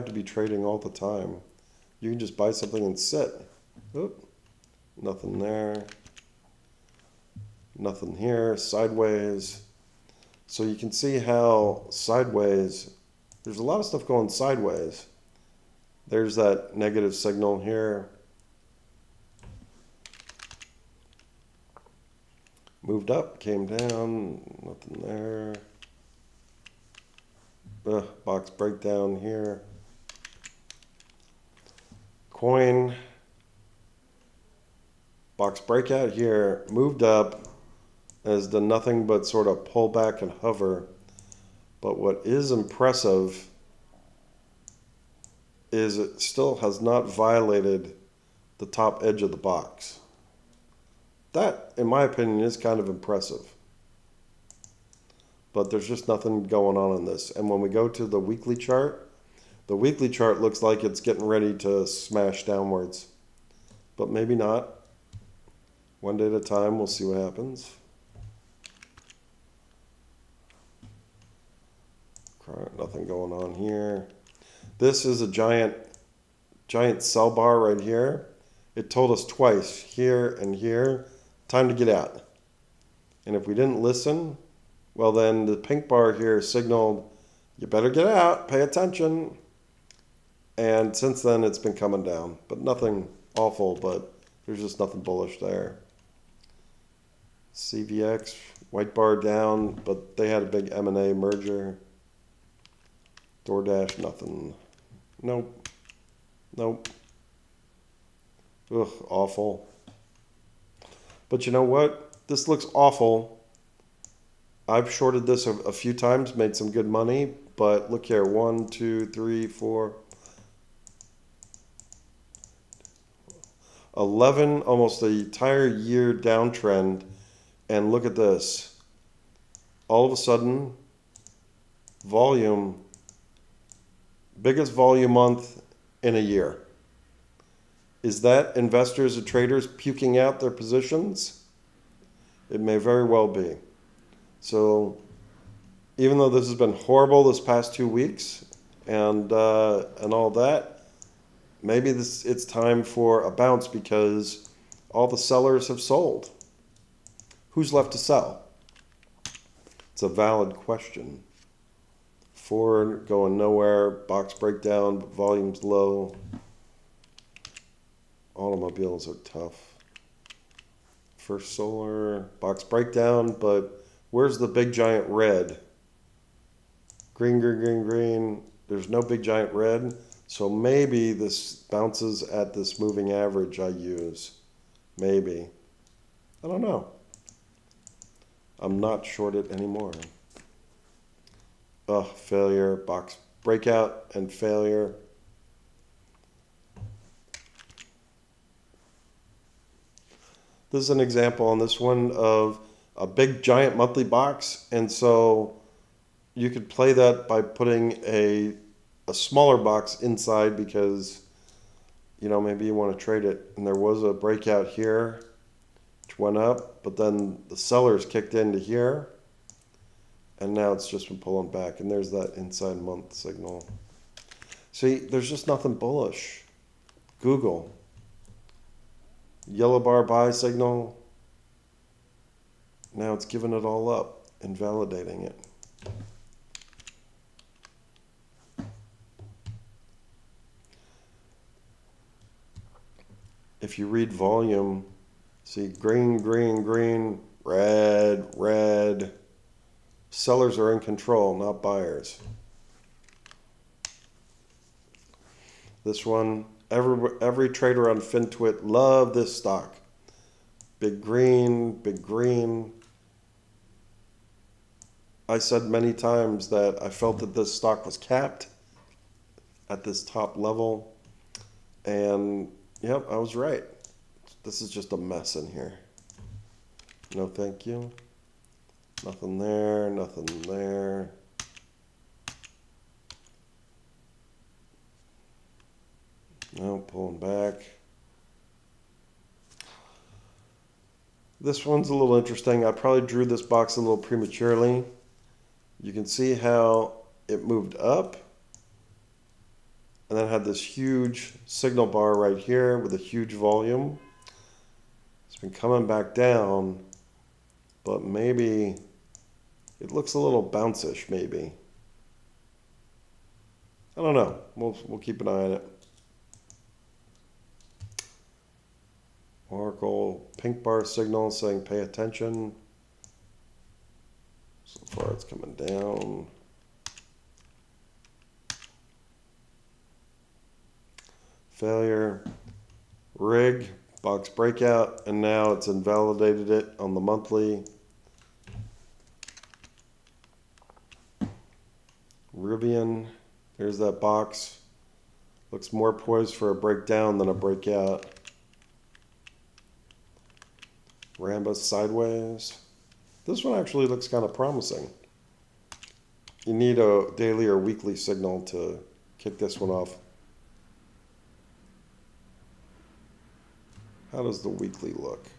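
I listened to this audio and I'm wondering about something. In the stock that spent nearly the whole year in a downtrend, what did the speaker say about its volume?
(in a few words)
biggest volume month in a year.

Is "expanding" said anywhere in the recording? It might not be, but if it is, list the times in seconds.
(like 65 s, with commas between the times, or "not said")
not said.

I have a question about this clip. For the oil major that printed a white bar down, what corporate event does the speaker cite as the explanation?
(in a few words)
M&A merger.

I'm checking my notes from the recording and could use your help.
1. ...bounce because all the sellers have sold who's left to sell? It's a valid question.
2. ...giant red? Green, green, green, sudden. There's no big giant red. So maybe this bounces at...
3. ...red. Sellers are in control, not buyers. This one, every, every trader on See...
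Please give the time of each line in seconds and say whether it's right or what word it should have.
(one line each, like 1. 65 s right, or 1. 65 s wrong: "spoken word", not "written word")
1. 153 s right
2. 174 s wrong: "green", not "sudden"
3. 248 s wrong: "FinTwit", not "See".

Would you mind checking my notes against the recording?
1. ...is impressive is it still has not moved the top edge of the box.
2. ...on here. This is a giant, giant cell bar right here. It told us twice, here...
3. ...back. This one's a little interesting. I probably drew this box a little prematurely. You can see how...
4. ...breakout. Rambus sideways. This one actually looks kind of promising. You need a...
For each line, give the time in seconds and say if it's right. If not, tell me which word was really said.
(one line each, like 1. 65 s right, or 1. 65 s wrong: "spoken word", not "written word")
1. 42 s wrong: "violated", not "moved"
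2. 73 s right
3. 287 s right
4. 347 s right.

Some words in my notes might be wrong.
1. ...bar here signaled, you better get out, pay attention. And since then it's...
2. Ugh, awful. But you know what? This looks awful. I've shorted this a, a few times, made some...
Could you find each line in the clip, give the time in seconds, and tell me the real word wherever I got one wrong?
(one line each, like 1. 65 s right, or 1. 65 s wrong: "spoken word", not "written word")
1. 85 s right
2. 108 s right.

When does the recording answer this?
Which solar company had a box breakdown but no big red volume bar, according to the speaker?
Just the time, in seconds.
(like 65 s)
171 s.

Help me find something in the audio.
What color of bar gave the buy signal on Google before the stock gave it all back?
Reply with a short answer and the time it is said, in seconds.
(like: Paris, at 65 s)
Yellow, at 229 s.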